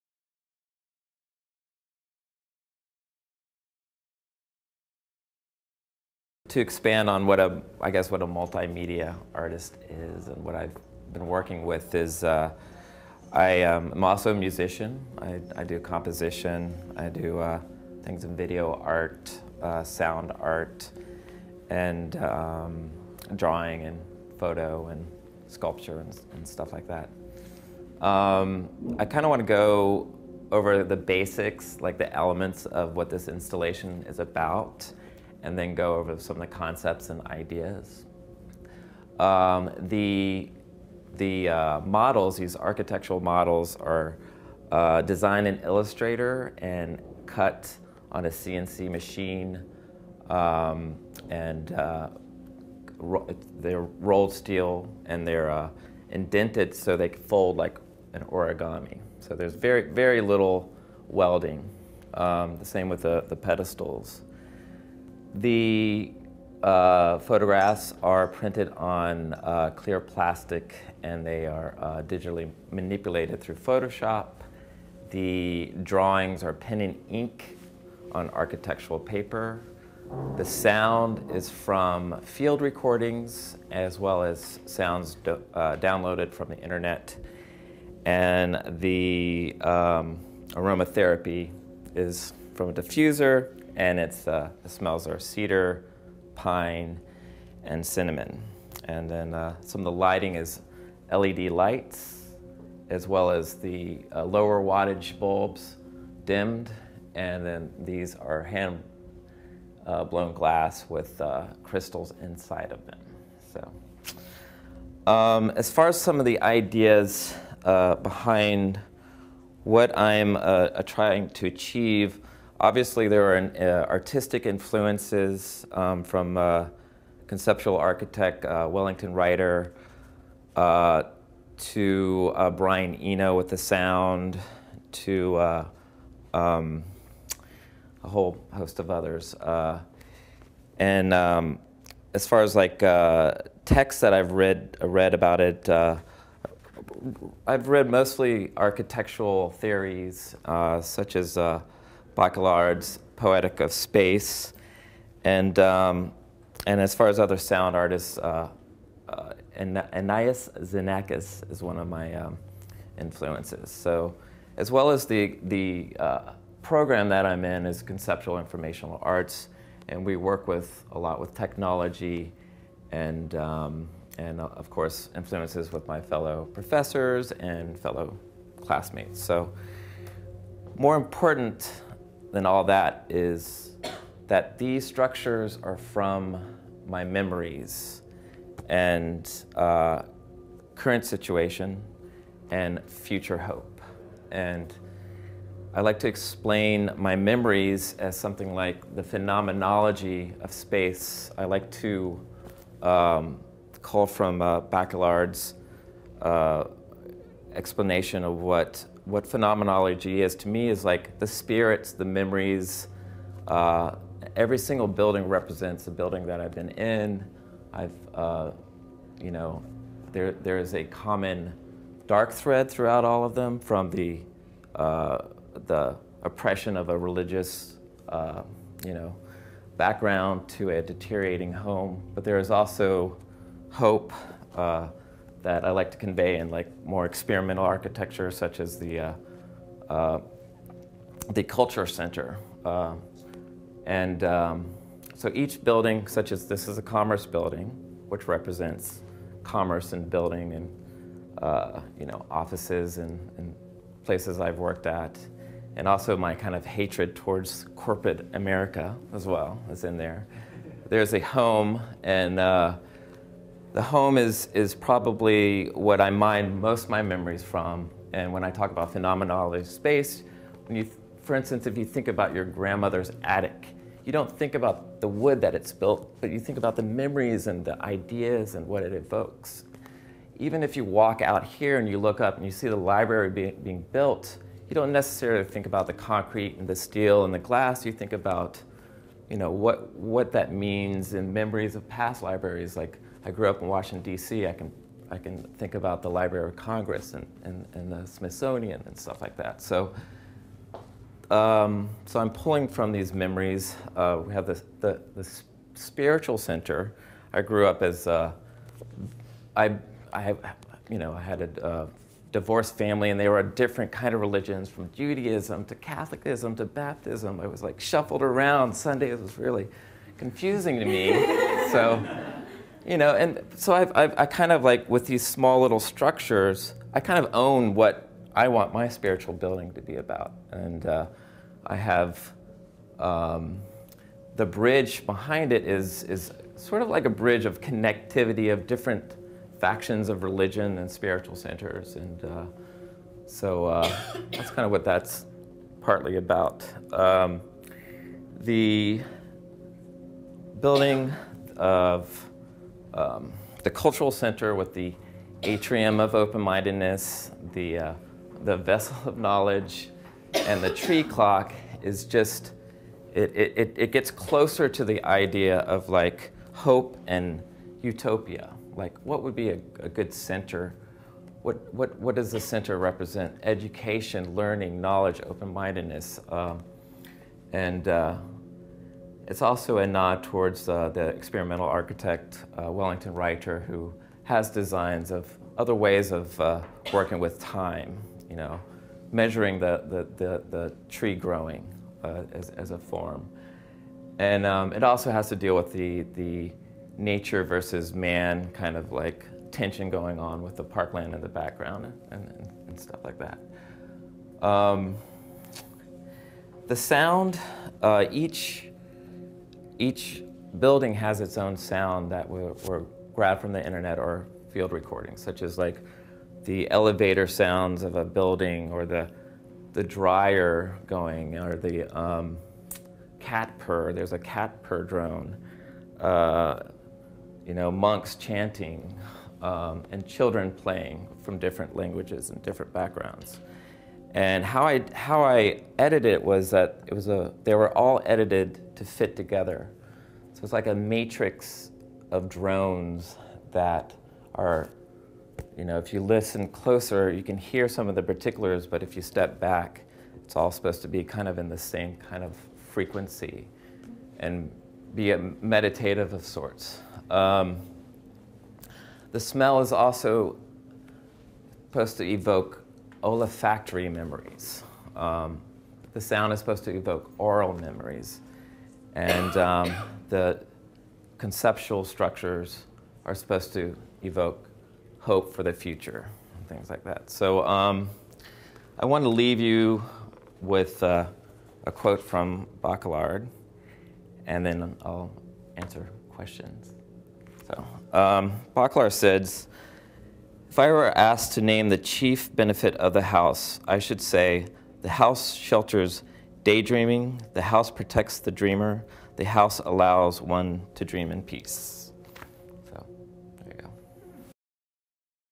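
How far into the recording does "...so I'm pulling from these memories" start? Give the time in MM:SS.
05:02.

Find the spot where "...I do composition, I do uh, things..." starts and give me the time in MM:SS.
00:15.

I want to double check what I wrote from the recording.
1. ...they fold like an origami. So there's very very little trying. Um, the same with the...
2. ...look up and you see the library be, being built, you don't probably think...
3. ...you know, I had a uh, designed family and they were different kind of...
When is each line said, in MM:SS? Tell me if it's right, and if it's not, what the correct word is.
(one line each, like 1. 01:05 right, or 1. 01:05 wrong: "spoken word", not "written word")
1. 00:56 wrong: "welding", not "trying"
2. 04:41 wrong: "necessarily", not "probably"
3. 05:10 wrong: "divorced", not "designed".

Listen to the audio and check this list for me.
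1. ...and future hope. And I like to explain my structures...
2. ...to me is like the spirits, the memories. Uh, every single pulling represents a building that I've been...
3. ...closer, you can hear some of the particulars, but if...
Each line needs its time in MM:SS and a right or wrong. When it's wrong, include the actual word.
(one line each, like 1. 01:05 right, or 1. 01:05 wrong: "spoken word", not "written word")
1. 03:12 wrong: "memories", not "structures"
2. 03:30 wrong: "building", not "pulling"
3. 07:26 right.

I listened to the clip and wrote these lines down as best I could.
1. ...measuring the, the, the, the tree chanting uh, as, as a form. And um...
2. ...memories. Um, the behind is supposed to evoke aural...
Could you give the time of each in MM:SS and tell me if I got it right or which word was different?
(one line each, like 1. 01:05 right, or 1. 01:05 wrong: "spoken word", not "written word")
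1. 06:29 wrong: "growing", not "chanting"
2. 07:43 wrong: "sound", not "behind".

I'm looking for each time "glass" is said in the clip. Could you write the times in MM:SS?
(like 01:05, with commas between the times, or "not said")
01:50, 04:47.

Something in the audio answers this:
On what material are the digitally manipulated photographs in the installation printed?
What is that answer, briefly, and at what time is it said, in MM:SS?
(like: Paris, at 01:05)
clear plastic, at 01:09.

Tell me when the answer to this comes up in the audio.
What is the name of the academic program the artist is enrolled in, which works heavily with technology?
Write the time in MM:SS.
02:47.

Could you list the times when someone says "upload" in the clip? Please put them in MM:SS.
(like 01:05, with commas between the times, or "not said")
not said.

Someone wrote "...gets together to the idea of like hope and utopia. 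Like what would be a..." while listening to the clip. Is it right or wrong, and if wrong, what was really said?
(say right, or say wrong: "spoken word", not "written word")
wrong: "closer", not "together".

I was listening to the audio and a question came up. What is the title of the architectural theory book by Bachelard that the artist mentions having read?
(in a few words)
Poetic of Space.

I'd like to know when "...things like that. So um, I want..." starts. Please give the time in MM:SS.
07:56.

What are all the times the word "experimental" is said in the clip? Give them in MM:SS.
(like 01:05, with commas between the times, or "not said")
03:57, 06:21.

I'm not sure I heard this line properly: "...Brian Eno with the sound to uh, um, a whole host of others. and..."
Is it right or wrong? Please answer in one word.
right.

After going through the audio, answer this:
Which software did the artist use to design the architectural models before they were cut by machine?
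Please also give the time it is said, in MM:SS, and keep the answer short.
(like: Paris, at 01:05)
Illustrator, at 00:45.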